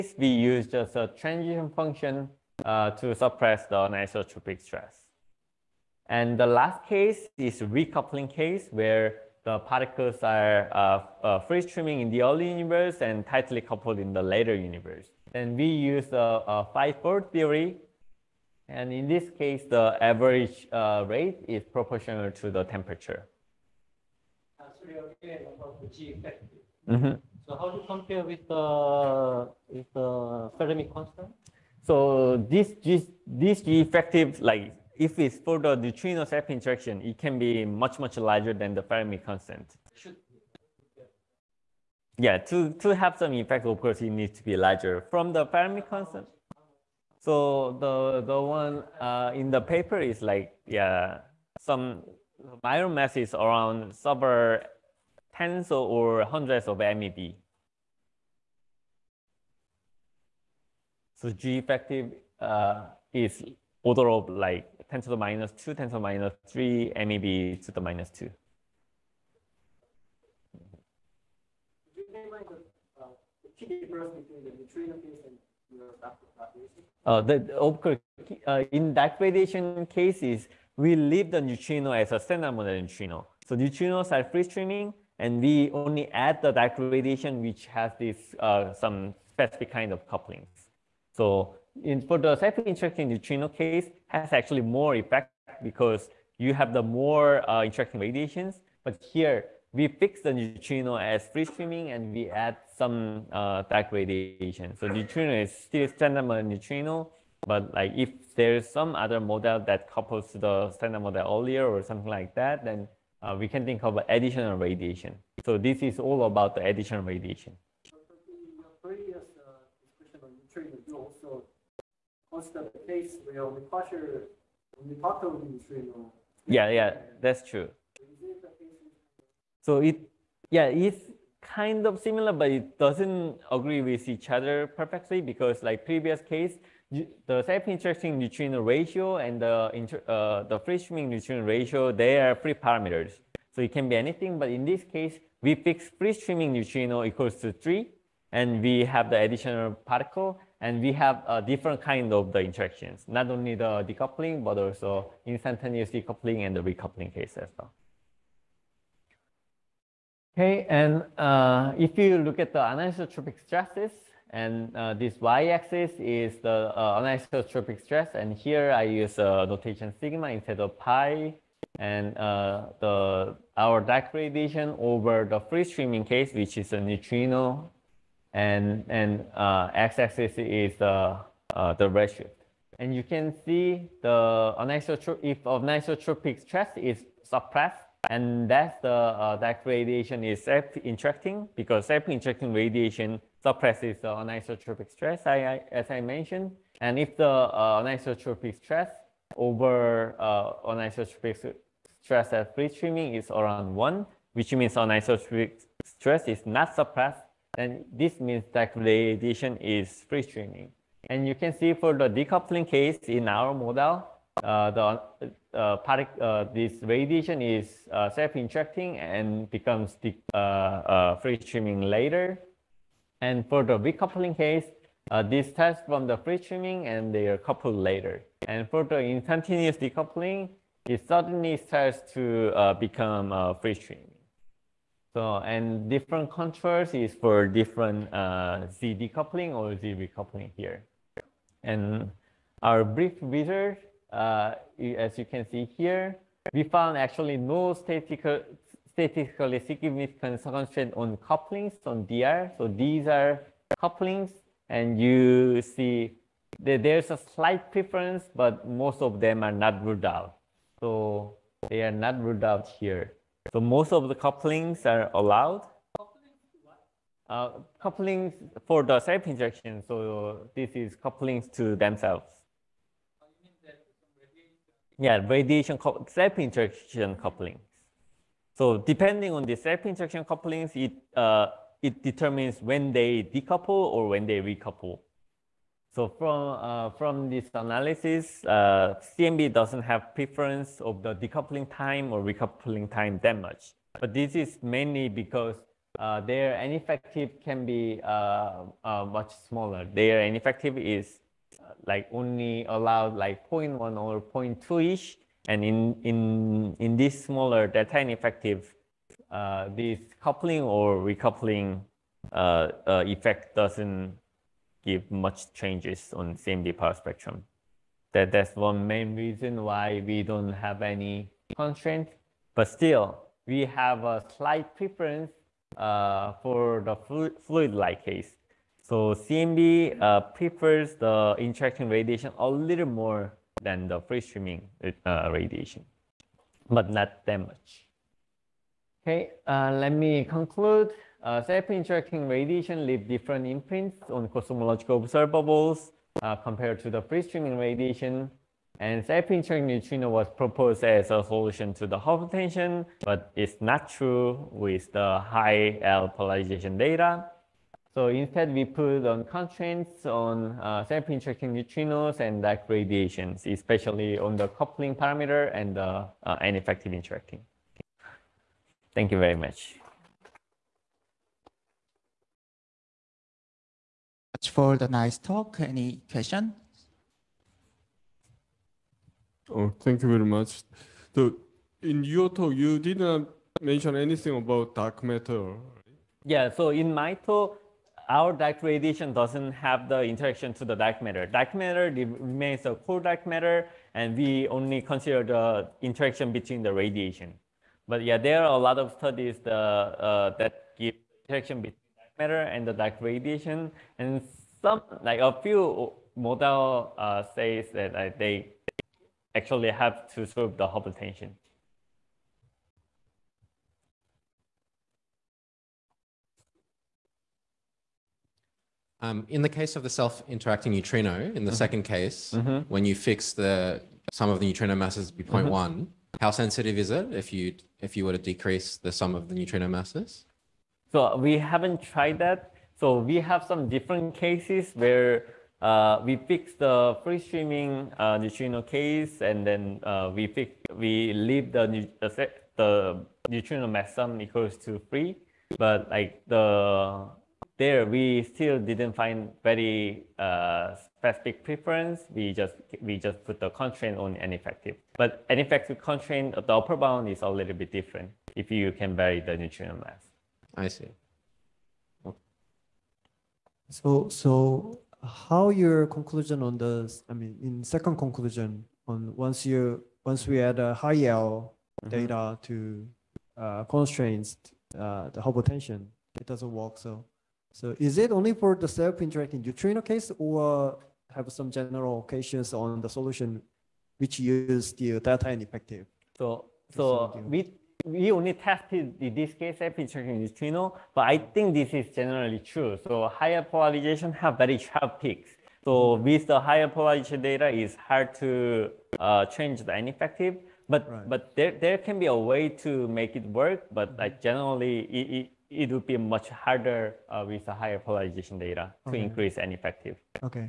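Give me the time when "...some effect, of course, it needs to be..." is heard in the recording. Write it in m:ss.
0:43.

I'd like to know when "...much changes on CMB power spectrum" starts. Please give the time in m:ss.
5:15.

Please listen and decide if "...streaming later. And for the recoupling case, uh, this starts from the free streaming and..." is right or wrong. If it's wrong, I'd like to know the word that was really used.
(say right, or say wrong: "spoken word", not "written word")
right.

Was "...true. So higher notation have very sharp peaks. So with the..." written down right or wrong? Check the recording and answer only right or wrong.
wrong.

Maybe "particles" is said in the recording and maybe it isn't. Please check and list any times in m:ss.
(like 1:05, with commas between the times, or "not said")
0:09, 2:29.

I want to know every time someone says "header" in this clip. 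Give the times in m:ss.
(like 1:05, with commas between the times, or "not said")
not said.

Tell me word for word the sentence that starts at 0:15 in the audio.
Then we use a, a five-fold theory.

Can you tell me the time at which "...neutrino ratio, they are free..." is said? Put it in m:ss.
2:21.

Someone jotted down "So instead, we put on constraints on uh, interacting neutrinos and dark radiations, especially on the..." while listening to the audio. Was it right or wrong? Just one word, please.
right.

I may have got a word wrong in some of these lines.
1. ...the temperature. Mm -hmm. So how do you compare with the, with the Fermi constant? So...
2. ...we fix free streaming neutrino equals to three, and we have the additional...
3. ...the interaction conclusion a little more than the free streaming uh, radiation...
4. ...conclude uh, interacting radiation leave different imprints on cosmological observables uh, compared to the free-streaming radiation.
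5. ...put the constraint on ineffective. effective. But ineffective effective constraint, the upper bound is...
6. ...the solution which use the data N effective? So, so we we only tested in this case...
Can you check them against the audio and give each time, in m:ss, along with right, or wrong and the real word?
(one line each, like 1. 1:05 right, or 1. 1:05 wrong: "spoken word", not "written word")
1. 0:22 right
2. 2:25 right
3. 5:30 wrong: "radiation", not "conclusion"
4. 5:40 right
5. 7:33 right
6. 8:02 right.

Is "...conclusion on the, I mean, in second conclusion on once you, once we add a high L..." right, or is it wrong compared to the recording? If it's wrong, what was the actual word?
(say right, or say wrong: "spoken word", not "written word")
right.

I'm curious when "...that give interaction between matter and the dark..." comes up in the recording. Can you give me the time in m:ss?
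6:40.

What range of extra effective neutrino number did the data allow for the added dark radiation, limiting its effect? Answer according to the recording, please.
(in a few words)
0.1 or 0.2.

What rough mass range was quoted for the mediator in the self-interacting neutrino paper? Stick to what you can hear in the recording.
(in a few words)
several tens or hundreds of MeV.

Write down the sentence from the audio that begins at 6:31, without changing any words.
Dark matter remains a core dark matter, and we only consider the interaction between the radiation.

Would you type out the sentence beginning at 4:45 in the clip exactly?
So from, uh, from this analysis, uh, CMB doesn't have preference of the decoupling time or recoupling time that much.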